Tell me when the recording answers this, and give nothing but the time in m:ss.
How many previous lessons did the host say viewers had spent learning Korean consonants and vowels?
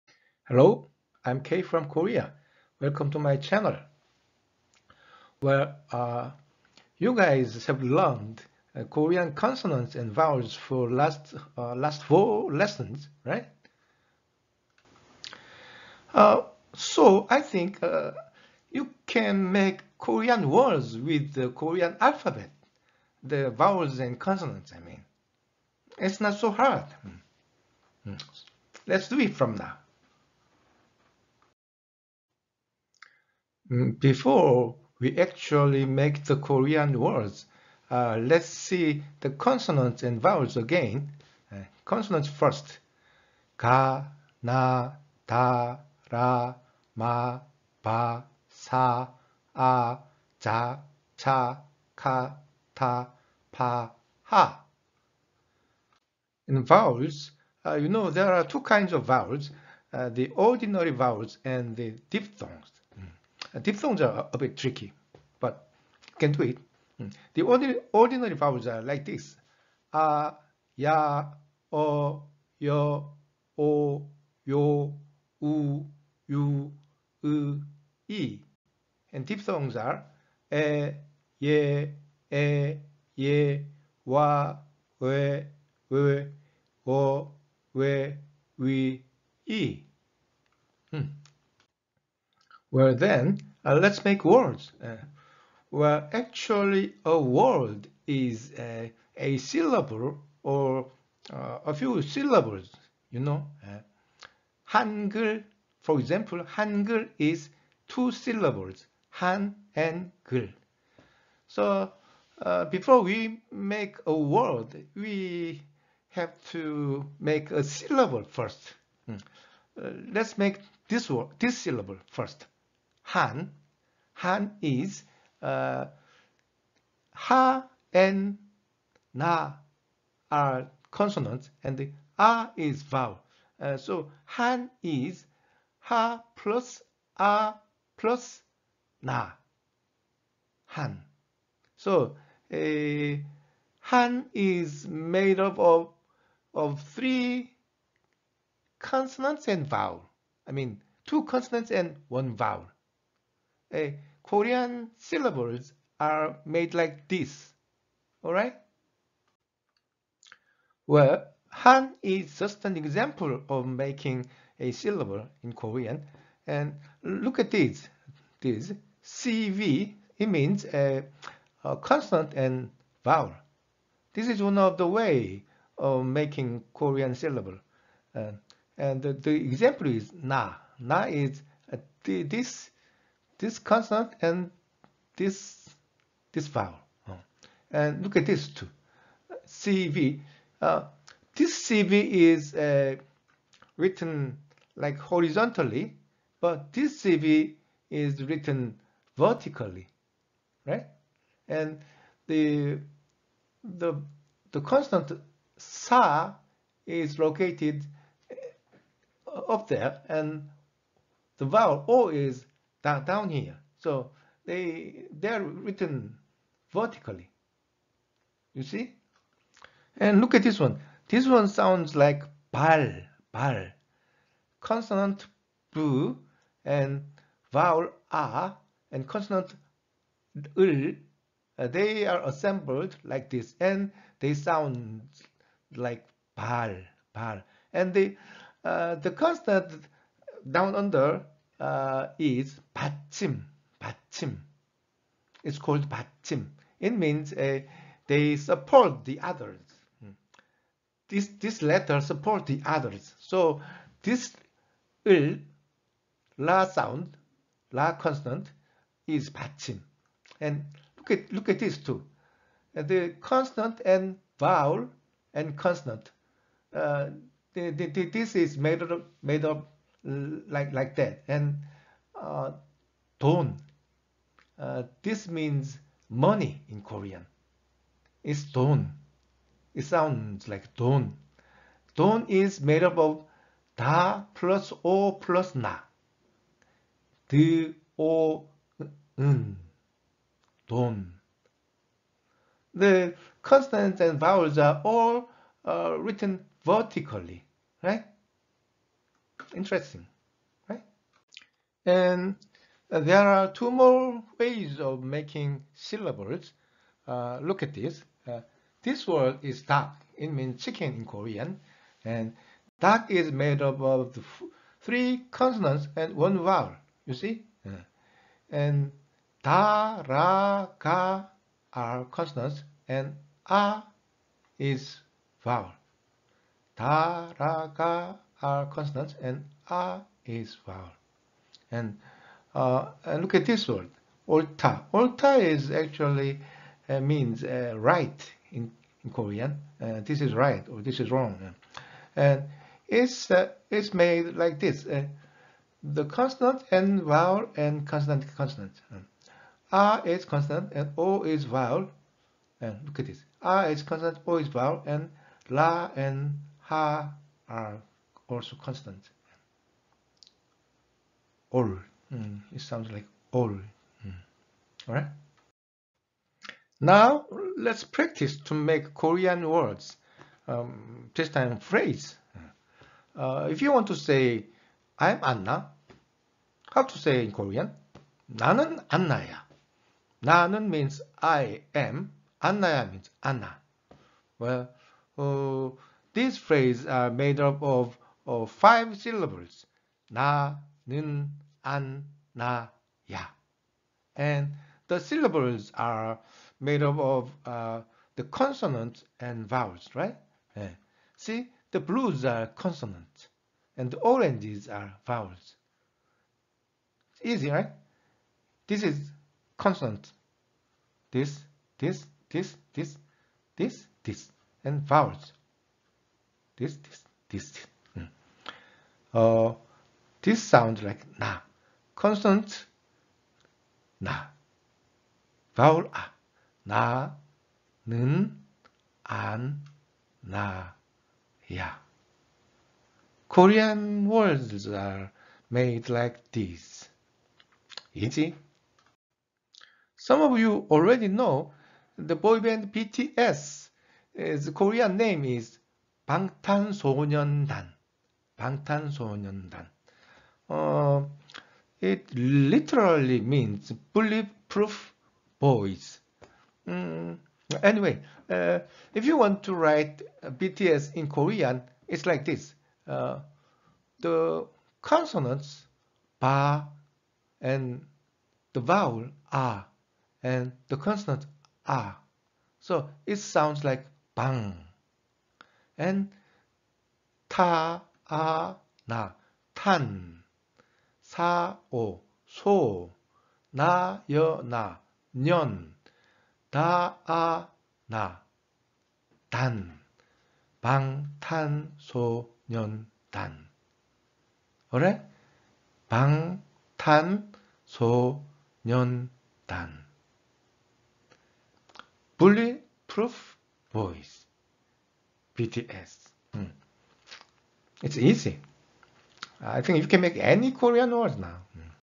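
0:12.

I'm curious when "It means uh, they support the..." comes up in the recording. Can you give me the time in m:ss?
4:06.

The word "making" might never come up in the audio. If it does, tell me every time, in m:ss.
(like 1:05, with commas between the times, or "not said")
2:43, 2:56, 5:05.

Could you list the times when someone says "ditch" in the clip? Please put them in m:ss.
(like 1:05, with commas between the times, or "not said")
not said.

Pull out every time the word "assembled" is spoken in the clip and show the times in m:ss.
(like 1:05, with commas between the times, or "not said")
3:52.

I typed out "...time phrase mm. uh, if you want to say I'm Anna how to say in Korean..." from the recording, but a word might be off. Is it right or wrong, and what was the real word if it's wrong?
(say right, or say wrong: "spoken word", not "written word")
right.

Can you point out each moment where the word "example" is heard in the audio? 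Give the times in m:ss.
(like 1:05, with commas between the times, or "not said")
1:45, 2:42, 2:59.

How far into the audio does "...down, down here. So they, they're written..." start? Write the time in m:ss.
3:32.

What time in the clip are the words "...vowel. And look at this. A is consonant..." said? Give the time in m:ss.
5:51.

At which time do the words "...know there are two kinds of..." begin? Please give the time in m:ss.
0:57.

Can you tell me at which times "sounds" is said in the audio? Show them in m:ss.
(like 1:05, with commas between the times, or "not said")
3:41, 3:54, 4:16, 4:39, 6:02, 7:00, 7:53.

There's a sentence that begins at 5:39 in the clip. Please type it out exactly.
Uh, this is right or this is wrong.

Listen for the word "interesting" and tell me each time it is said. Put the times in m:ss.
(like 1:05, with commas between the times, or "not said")
4:59.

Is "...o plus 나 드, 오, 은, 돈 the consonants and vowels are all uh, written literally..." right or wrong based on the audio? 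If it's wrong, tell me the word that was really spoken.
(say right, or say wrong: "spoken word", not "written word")
wrong: "vertically", not "literally".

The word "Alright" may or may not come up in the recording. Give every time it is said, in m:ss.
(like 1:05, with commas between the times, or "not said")
2:38.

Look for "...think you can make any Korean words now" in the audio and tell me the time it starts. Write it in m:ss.
8:29.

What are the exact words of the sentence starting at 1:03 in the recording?
Diphthongs are a bit tricky, but can do it.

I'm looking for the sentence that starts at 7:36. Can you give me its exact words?
Um, anyway, uh, if you want to write BTS in Korean, it's like this.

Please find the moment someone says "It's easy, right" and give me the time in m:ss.
6:47.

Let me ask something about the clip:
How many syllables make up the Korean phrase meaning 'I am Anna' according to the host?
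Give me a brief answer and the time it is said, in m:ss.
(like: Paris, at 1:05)
5, at 6:28.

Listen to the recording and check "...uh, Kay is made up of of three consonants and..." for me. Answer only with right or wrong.
wrong.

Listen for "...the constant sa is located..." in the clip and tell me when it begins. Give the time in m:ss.
3:24.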